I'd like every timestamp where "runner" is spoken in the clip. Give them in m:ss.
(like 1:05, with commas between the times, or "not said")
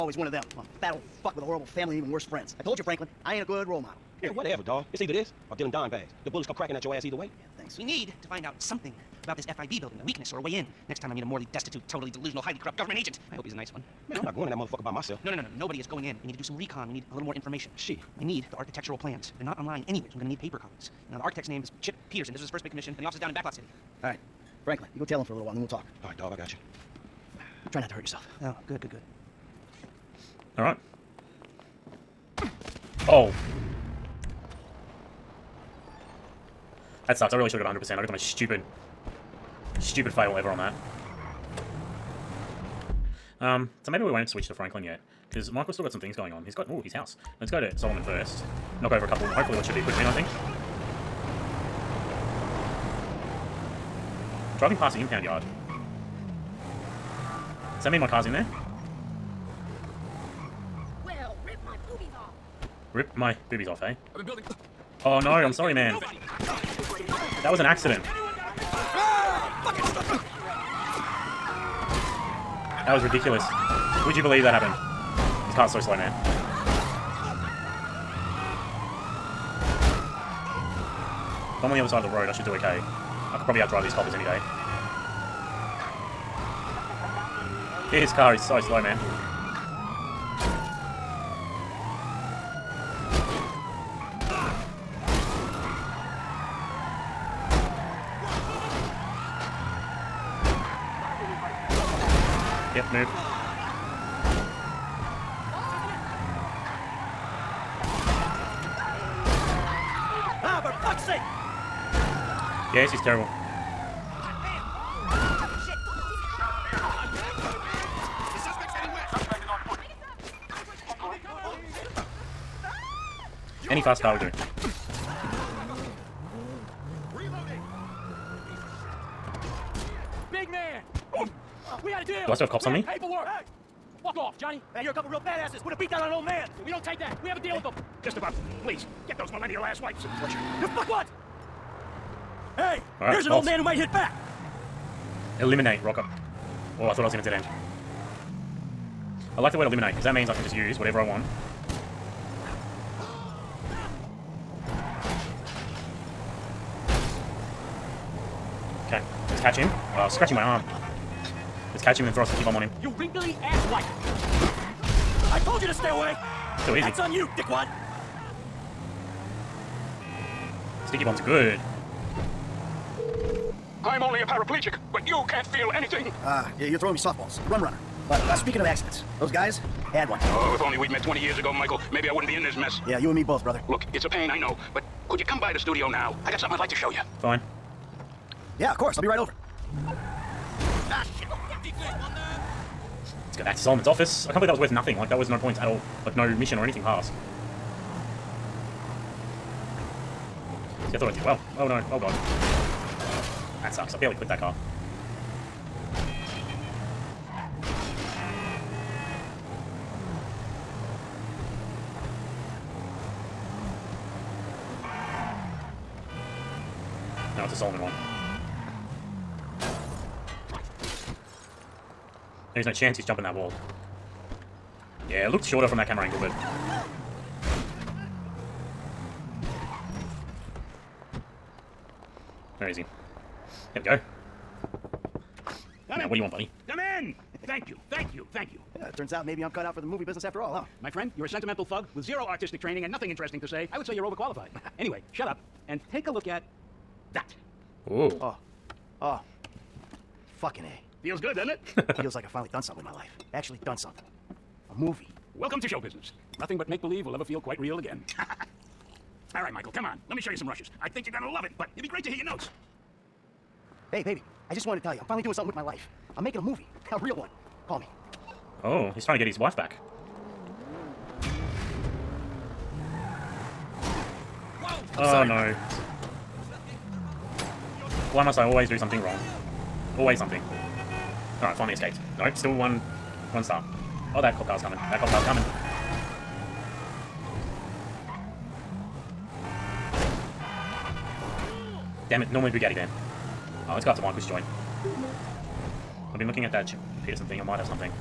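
2:57.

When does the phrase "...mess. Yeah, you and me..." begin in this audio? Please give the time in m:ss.
3:02.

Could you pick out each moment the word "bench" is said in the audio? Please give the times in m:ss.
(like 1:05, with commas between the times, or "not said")
not said.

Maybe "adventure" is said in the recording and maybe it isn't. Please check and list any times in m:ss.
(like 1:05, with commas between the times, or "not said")
not said.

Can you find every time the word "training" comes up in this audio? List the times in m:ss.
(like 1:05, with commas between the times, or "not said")
4:02.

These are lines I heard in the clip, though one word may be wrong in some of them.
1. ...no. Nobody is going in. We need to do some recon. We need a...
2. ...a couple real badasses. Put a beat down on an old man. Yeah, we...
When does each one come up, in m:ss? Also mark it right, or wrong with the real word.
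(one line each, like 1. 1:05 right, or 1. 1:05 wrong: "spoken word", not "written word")
1. 0:15 right
2. 2:14 right.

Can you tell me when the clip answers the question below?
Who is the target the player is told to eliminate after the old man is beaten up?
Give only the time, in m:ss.
2:25.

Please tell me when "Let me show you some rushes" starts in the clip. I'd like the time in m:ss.
4:20.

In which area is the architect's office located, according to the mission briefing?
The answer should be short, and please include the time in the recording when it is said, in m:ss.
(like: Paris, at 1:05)
Backlot City, at 0:23.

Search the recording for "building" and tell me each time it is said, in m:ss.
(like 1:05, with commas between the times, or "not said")
0:09, 1:04.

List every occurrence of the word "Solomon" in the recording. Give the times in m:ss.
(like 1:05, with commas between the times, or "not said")
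0:47, 3:13, 3:37.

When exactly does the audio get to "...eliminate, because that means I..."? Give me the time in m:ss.
2:29.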